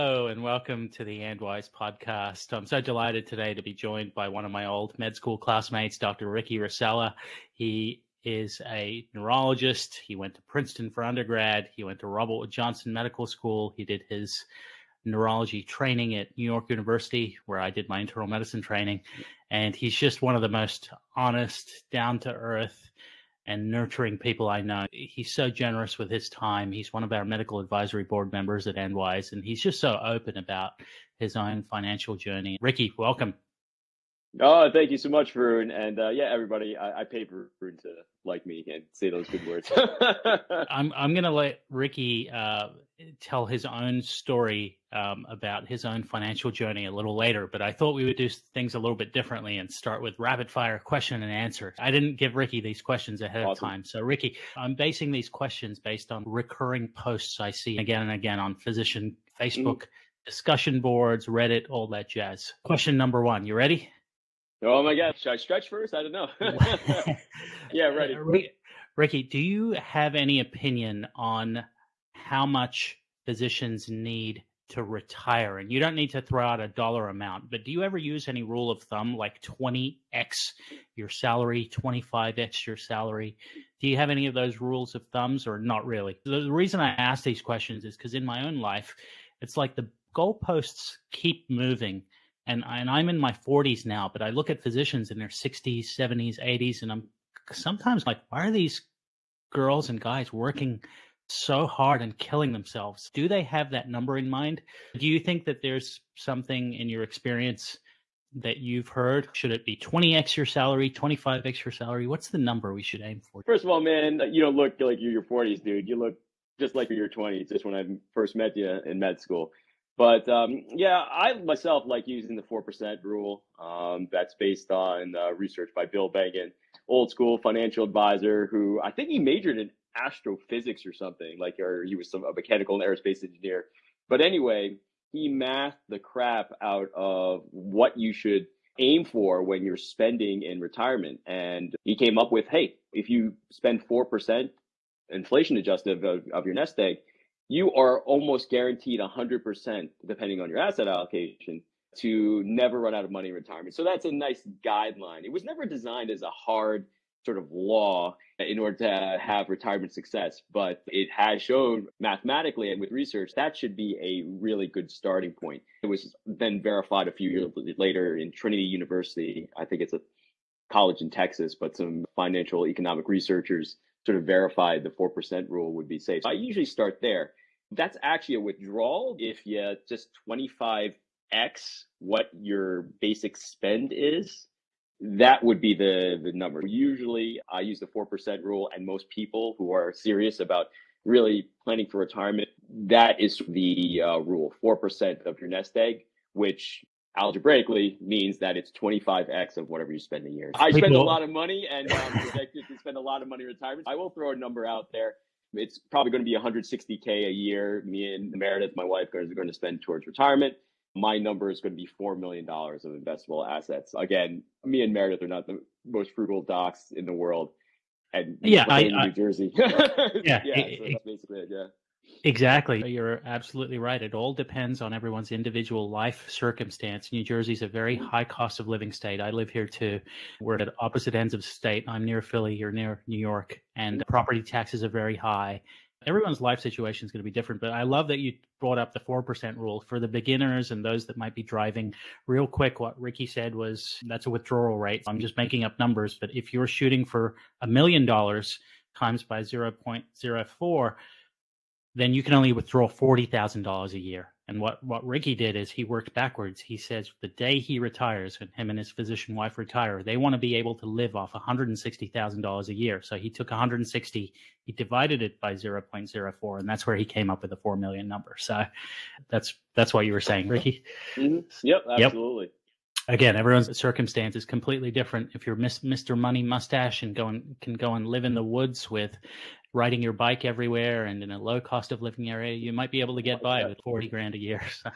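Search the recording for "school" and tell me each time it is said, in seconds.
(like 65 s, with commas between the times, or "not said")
5 s, 13 s, 119 s, 127 s.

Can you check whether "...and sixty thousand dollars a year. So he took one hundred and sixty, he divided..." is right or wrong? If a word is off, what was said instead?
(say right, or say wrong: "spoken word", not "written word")
right.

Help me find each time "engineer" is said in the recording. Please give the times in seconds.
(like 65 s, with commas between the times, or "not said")
133 s.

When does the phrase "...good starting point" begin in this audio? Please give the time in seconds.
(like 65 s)
164 s.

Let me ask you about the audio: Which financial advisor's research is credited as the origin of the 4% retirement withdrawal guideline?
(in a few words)
Bill Bengen.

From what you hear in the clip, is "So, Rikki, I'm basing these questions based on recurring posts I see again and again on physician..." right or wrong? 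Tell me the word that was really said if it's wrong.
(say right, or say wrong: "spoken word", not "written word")
right.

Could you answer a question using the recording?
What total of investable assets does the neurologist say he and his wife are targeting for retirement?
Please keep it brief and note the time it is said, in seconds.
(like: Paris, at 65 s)
$4 million, at 211 s.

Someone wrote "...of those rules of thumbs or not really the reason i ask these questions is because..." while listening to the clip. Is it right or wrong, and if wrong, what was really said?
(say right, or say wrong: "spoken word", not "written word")
right.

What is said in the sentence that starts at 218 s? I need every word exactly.
And yeah, I, New I, Jersey.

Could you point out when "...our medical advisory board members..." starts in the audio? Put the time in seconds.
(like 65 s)
27 s.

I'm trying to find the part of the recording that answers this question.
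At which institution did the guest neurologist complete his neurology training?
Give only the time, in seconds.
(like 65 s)
16 s.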